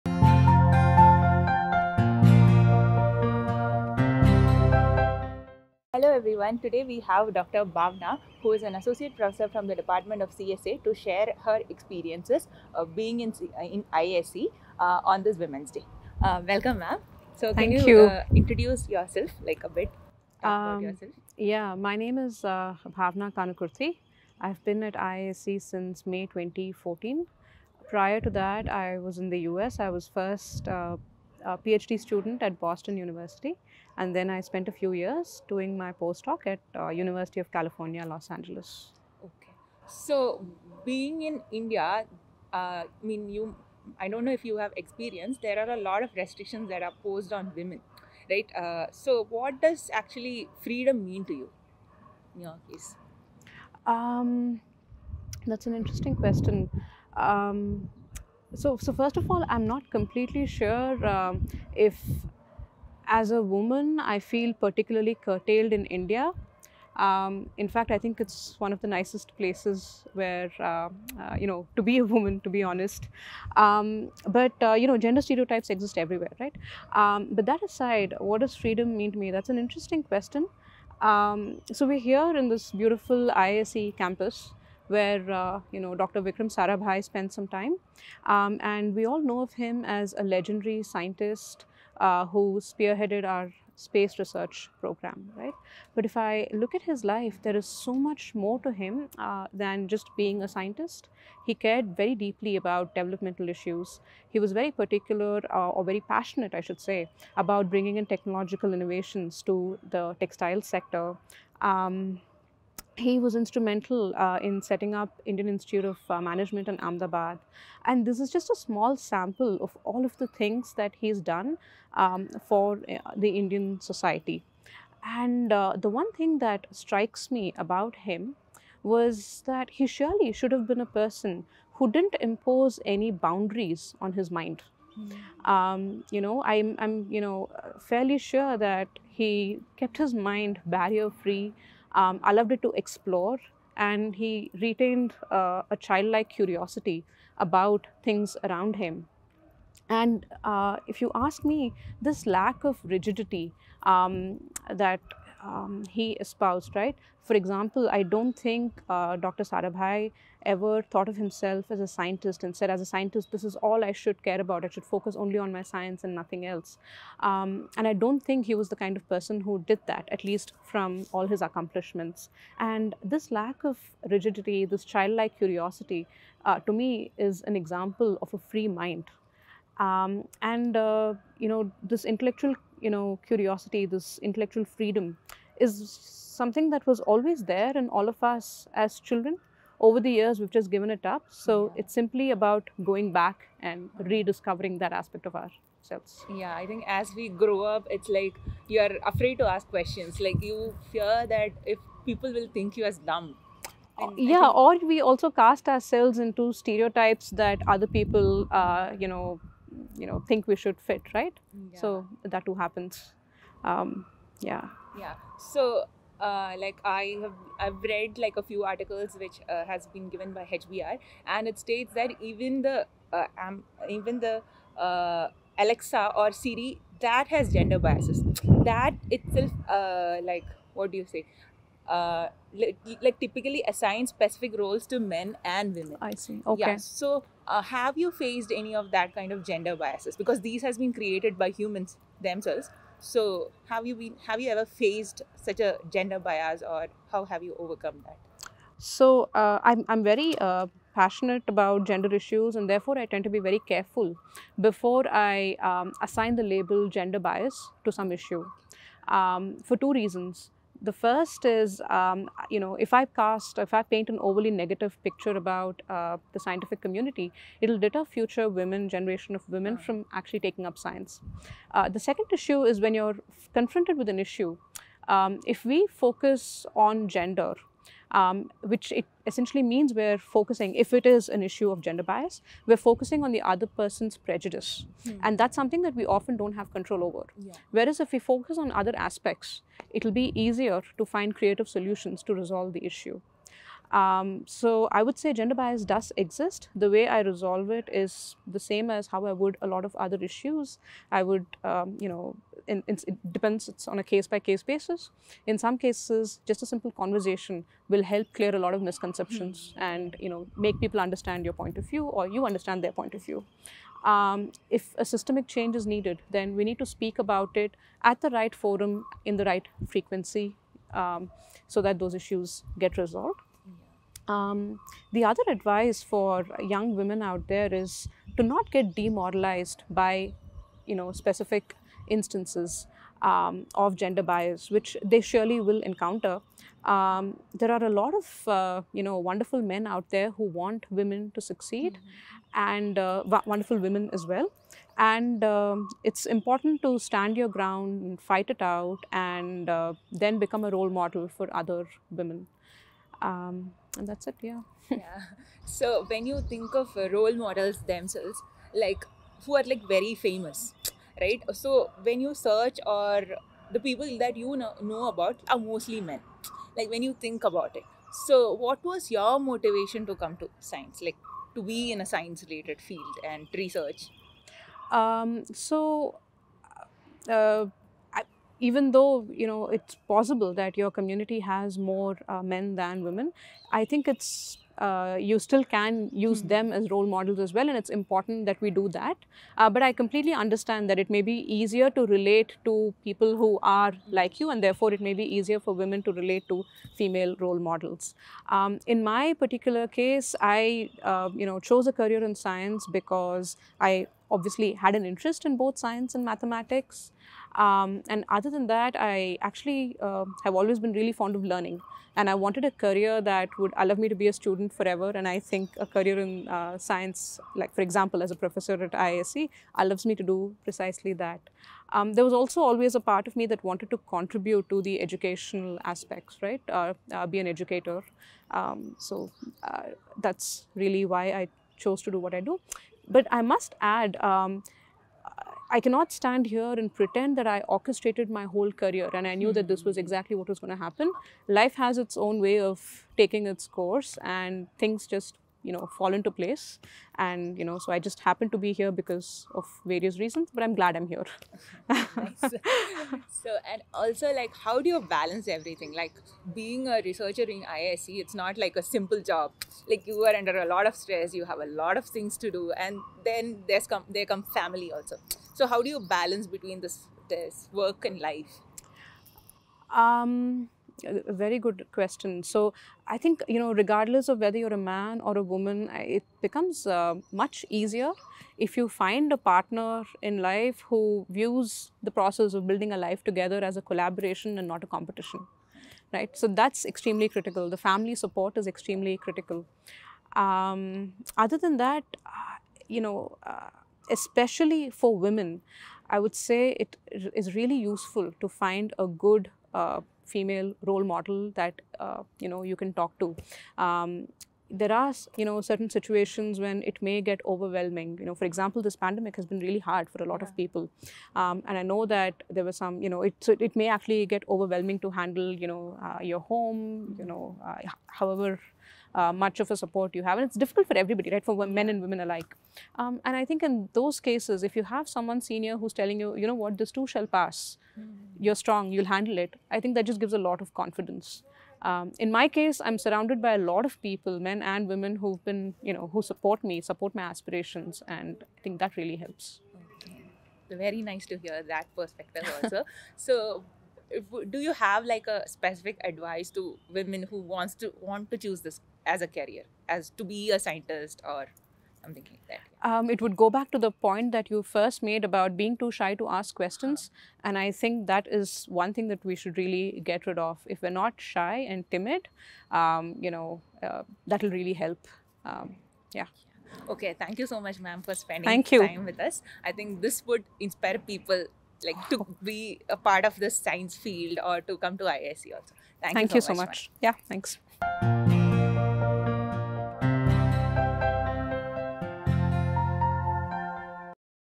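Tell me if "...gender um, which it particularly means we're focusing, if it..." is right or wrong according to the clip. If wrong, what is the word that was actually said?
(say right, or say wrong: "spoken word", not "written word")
wrong: "essentially", not "particularly".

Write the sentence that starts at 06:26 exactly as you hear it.
them as role models as well, and it's important that we do that.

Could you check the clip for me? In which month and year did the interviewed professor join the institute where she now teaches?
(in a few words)
May 2014.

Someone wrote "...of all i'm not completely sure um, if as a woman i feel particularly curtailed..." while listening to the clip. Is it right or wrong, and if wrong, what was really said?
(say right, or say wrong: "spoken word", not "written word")
right.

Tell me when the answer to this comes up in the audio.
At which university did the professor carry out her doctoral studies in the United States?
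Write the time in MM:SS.
00:32.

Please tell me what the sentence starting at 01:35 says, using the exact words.
But if I look at his life, there is so much more to him uh, than just being a scientist.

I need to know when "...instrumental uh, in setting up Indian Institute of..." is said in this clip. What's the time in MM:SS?
01:53.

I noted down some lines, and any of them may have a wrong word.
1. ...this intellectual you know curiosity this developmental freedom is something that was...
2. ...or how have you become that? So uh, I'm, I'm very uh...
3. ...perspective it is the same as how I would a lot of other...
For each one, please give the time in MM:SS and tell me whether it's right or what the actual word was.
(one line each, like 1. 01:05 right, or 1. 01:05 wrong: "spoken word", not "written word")
1. 03:01 wrong: "intellectual", not "developmental"
2. 04:06 wrong: "overcome", not "become"
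3. 04:57 wrong: "resolve", not "perspective".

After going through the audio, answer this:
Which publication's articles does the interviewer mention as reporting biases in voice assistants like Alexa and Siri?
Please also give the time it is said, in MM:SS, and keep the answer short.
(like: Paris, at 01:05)
HBR, at 03:40.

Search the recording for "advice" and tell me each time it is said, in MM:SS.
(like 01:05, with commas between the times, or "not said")
05:25, 09:06.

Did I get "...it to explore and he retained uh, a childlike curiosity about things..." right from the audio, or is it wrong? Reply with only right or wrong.
right.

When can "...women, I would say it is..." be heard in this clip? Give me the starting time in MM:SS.
08:15.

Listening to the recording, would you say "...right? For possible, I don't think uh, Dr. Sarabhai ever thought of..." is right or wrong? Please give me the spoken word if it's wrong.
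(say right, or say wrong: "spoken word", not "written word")
wrong: "example", not "possible".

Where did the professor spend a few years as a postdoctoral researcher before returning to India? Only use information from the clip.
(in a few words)
University of California, Los Angeles.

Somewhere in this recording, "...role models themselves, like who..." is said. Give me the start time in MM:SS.
05:57.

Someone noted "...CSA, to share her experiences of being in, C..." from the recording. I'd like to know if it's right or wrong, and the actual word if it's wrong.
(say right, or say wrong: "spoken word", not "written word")
right.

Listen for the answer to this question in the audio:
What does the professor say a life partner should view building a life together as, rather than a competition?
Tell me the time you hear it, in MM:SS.
08:03.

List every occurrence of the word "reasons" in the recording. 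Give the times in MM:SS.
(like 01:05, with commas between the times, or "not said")
04:19, 07:30.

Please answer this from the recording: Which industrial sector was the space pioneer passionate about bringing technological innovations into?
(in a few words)
Textile sector.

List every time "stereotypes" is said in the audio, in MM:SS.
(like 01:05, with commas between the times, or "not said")
01:15, 03:26.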